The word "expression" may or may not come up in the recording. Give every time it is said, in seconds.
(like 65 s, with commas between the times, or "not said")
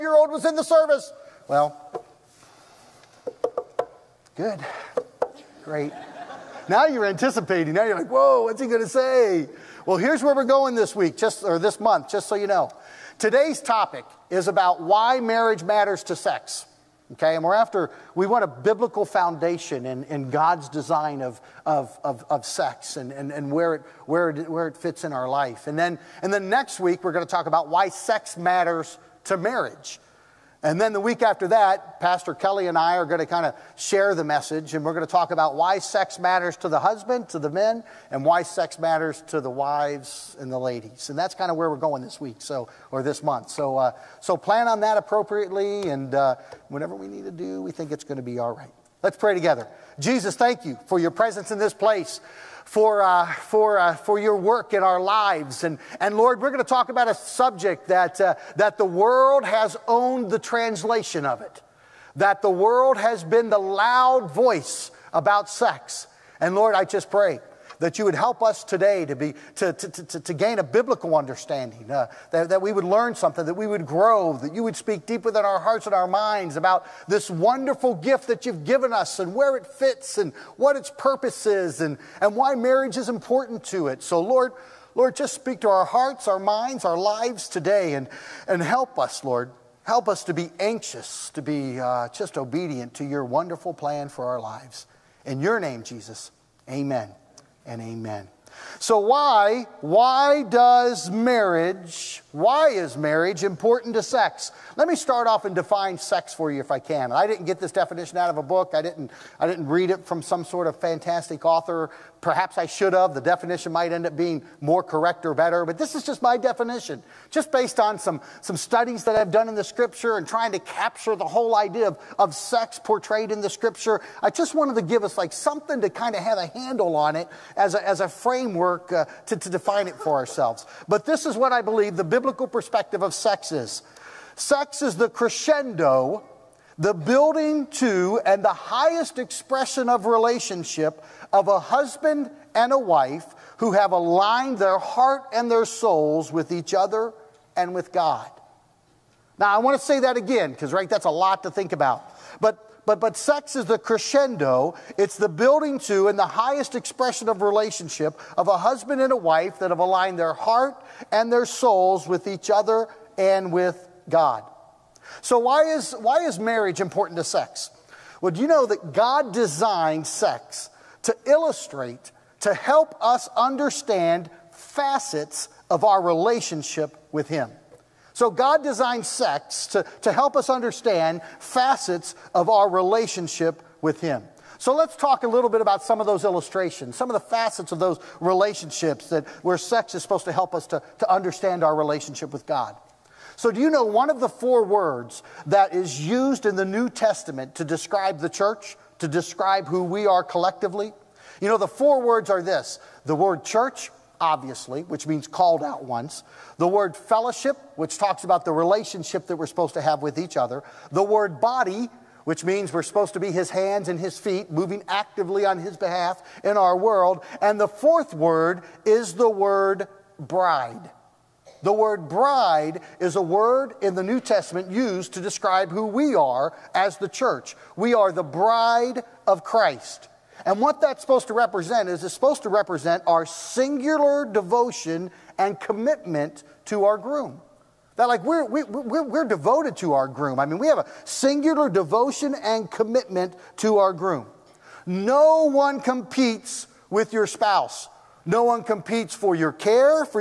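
139 s, 156 s.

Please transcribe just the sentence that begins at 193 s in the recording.
So do you know one of the four words that is used in the New Testament to describe the church?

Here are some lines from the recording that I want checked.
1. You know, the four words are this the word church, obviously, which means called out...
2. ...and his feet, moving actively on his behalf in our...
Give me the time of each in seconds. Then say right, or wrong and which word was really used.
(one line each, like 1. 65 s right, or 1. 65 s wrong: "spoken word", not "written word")
1. 201 s right
2. 213 s right.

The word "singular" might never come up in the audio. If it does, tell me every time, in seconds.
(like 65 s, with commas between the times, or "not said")
233 s, 241 s.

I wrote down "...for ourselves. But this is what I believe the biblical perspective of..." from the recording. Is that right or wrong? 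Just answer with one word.
right.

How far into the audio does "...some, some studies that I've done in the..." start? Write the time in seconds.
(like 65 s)
117 s.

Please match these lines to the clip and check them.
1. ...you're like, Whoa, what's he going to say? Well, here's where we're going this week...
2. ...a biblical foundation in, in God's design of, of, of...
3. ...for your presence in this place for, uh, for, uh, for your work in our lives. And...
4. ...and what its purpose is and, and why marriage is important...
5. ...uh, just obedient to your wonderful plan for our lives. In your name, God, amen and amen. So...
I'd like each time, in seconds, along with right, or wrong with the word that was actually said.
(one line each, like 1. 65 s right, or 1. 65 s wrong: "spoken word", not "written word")
1. 7 s right
2. 18 s right
3. 50 s right
4. 80 s right
5. 91 s wrong: "Jesus", not "God".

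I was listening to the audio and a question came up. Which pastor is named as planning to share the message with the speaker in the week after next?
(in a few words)
Pastor Kelly.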